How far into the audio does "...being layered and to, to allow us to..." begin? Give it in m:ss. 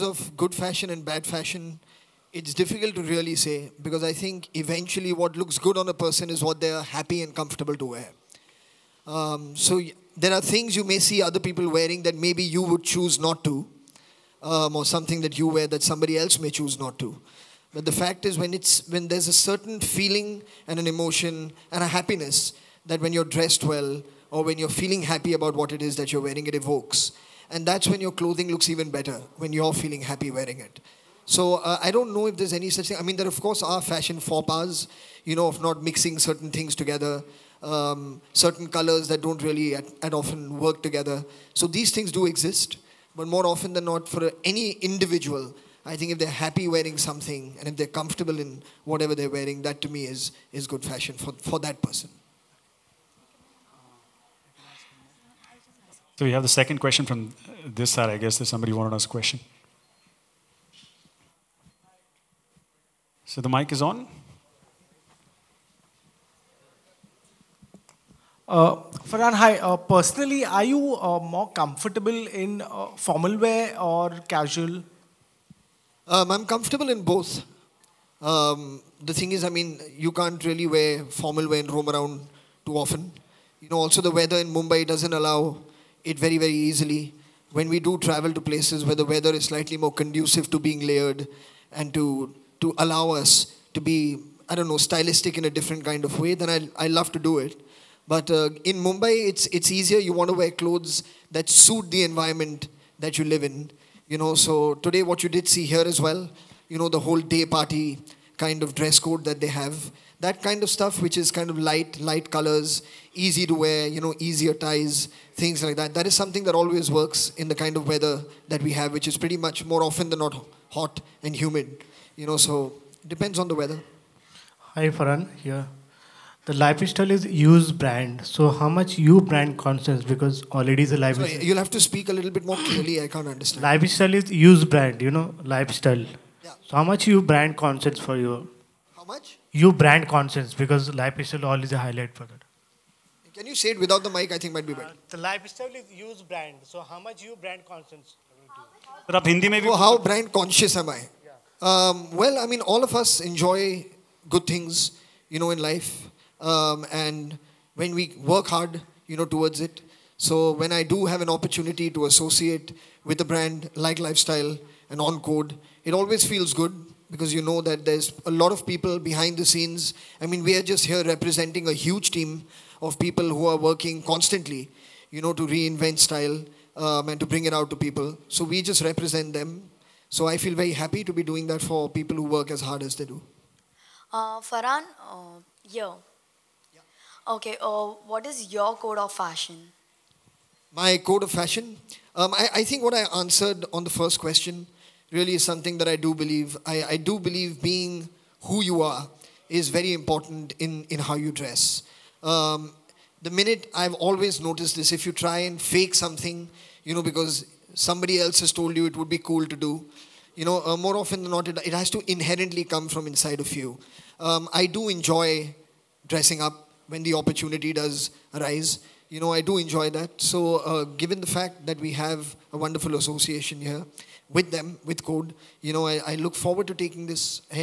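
1:30.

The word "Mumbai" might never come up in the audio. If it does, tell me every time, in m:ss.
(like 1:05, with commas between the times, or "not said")
1:24, 1:38.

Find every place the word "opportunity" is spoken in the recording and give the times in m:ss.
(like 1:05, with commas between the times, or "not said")
2:41, 3:37.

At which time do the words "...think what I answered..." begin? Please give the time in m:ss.
3:12.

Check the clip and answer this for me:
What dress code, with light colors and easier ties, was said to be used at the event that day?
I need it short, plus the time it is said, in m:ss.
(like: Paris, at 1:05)
Day party, at 1:47.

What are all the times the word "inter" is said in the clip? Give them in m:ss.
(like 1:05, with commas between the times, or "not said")
not said.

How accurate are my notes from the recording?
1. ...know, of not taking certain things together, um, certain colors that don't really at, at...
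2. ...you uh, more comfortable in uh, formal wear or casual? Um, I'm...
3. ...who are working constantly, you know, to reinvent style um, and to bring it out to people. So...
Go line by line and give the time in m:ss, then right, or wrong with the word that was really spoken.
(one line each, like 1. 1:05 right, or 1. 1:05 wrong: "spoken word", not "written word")
1. 0:35 wrong: "mixing", not "taking"
2. 1:10 right
3. 2:53 right.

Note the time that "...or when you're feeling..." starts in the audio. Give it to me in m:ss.
0:24.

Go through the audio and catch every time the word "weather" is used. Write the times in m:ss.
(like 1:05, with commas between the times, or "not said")
1:24, 1:29, 1:57, 2:03.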